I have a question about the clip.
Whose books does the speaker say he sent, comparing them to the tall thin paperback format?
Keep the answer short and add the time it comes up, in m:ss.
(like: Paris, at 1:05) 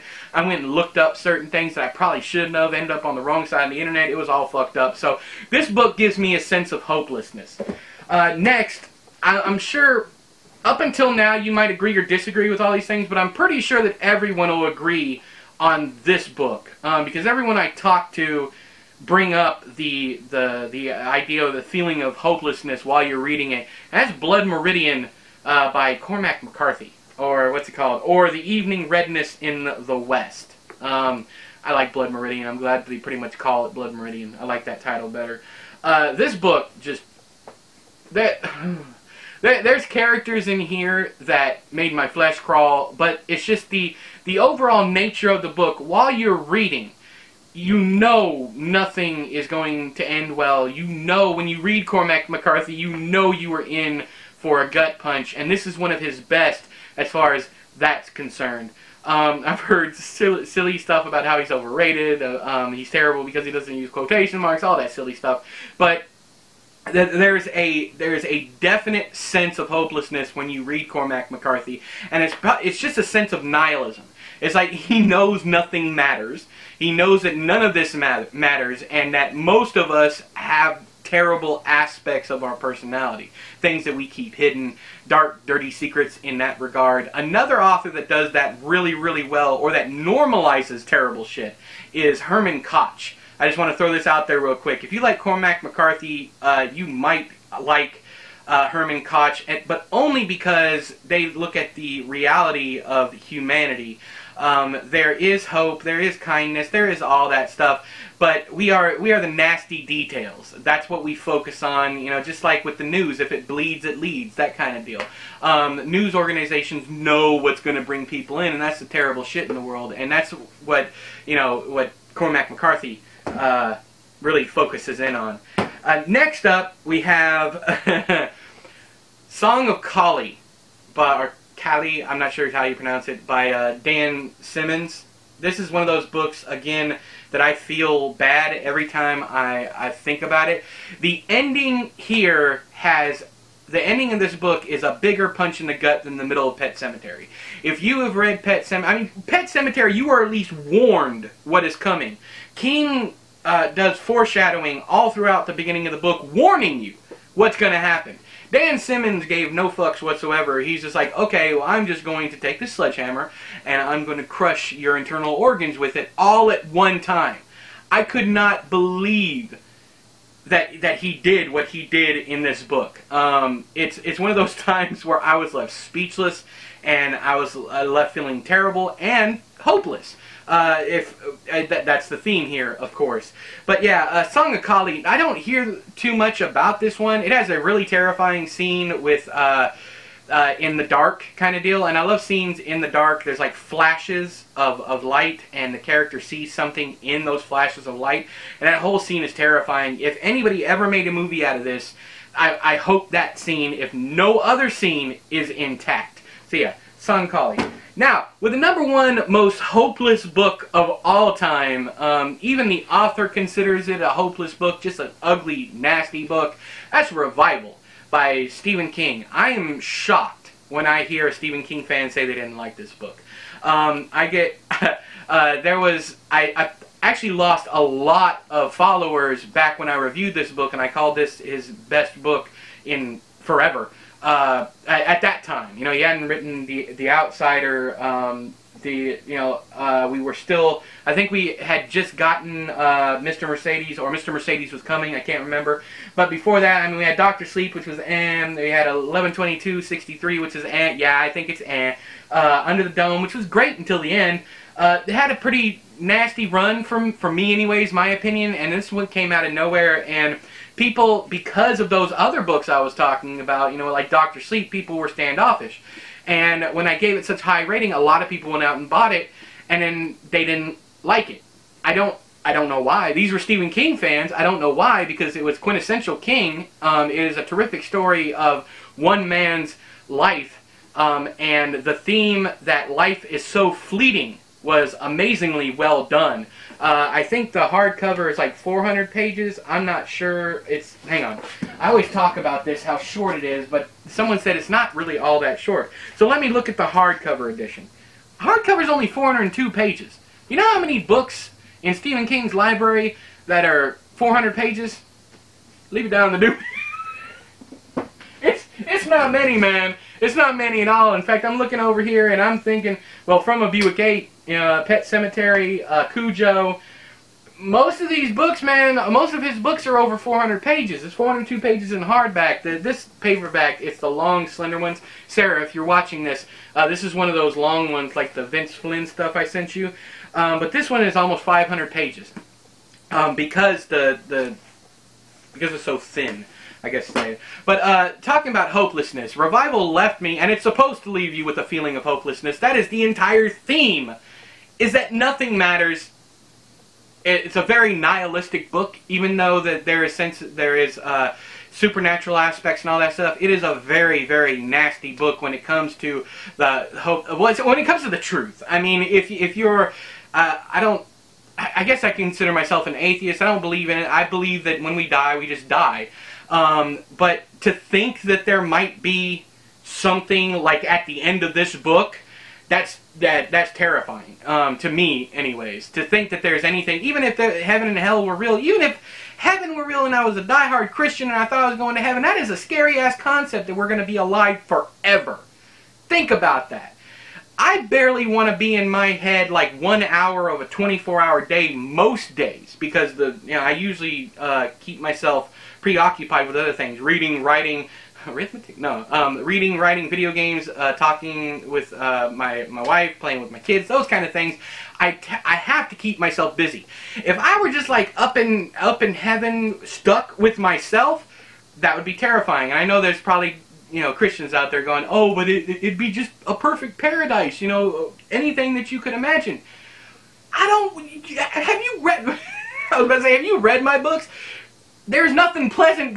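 Vince Flynn, at 5:28.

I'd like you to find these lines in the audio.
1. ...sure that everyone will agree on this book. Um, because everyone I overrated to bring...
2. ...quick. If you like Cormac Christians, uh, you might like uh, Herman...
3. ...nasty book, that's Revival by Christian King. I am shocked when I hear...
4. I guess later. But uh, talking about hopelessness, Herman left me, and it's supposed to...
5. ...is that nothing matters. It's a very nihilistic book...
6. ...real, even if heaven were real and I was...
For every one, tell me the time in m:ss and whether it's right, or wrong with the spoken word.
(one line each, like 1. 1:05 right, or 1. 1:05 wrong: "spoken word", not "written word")
1. 0:13 wrong: "talked", not "overrated"
2. 1:34 wrong: "McCarthy", not "Christians"
3. 3:35 wrong: "Stephen", not "Christian"
4. 5:36 wrong: "Revival", not "Herman"
5. 5:44 right
6. 6:18 right.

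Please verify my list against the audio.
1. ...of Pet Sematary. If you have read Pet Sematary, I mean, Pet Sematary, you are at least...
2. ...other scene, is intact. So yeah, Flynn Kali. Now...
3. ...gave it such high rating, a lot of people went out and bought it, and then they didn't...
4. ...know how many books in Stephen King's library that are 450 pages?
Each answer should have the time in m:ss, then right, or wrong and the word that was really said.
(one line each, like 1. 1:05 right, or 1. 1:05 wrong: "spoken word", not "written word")
1. 2:26 right
2. 3:24 wrong: "Song", not "Flynn"
3. 4:26 right
4. 5:00 wrong: "400", not "450".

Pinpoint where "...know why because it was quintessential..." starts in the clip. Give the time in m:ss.
4:34.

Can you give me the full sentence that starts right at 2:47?
I could not believe that that he did what he did in this book.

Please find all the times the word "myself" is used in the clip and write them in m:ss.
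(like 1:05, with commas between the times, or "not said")
6:02, 6:35, 6:46, 6:50.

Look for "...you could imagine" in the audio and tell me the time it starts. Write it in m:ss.
6:58.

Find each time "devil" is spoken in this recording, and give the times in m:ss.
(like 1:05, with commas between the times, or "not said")
not said.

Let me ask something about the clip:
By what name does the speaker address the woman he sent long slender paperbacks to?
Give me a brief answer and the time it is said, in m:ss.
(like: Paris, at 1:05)
Sarah, at 5:25.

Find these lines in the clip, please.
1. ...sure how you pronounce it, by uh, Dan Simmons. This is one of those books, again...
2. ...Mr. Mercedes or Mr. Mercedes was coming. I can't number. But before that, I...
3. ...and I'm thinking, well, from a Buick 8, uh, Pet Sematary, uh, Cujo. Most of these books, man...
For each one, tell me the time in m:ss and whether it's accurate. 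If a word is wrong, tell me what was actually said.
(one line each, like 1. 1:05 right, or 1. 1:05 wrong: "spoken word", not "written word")
1. 2:12 right
2. 4:03 wrong: "remember", not "number"
3. 5:12 right.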